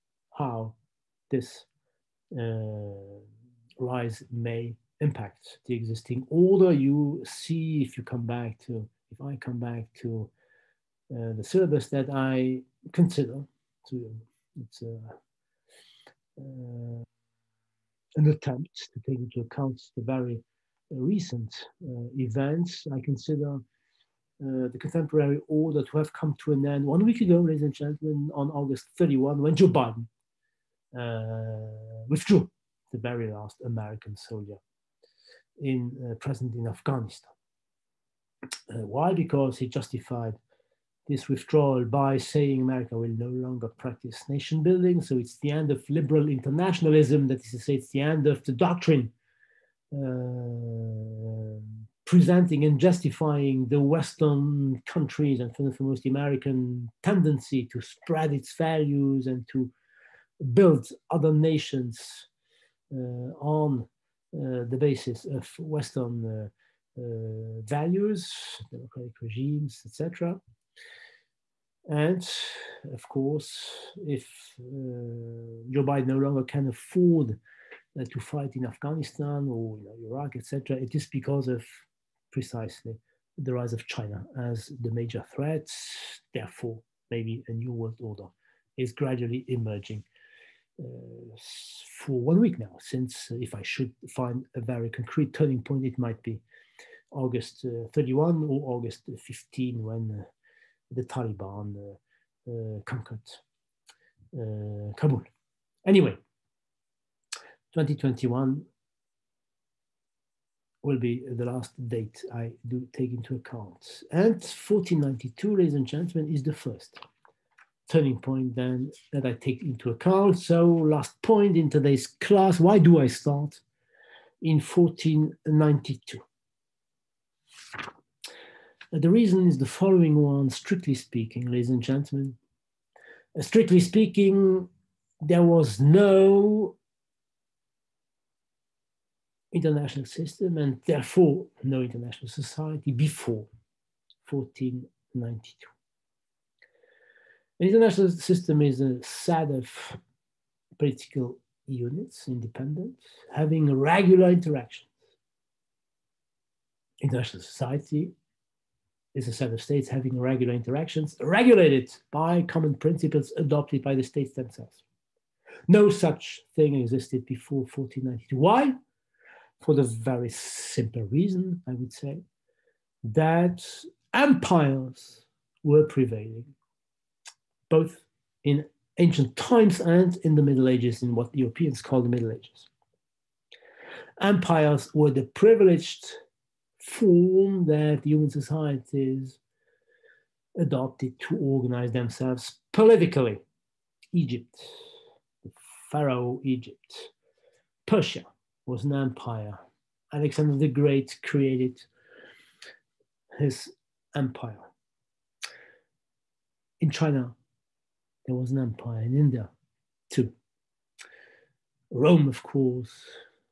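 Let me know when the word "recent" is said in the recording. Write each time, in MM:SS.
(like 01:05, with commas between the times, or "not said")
00:20.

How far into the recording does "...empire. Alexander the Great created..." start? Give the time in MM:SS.
03:18.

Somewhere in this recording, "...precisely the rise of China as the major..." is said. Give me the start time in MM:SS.
01:22.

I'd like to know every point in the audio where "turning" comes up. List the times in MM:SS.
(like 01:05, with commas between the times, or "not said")
01:35, 01:57.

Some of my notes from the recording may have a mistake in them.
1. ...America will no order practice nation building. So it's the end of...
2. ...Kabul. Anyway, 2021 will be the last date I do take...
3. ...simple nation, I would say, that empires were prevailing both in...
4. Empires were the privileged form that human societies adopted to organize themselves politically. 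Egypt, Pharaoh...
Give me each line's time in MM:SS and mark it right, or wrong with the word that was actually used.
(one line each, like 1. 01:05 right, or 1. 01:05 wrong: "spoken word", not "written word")
1. 00:42 wrong: "longer", not "order"
2. 01:44 right
3. 02:50 wrong: "reason", not "nation"
4. 03:04 right.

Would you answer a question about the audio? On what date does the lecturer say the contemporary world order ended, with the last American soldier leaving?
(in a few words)
August 31.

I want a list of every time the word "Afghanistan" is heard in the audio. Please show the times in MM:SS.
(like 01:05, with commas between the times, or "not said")
00:36, 01:18.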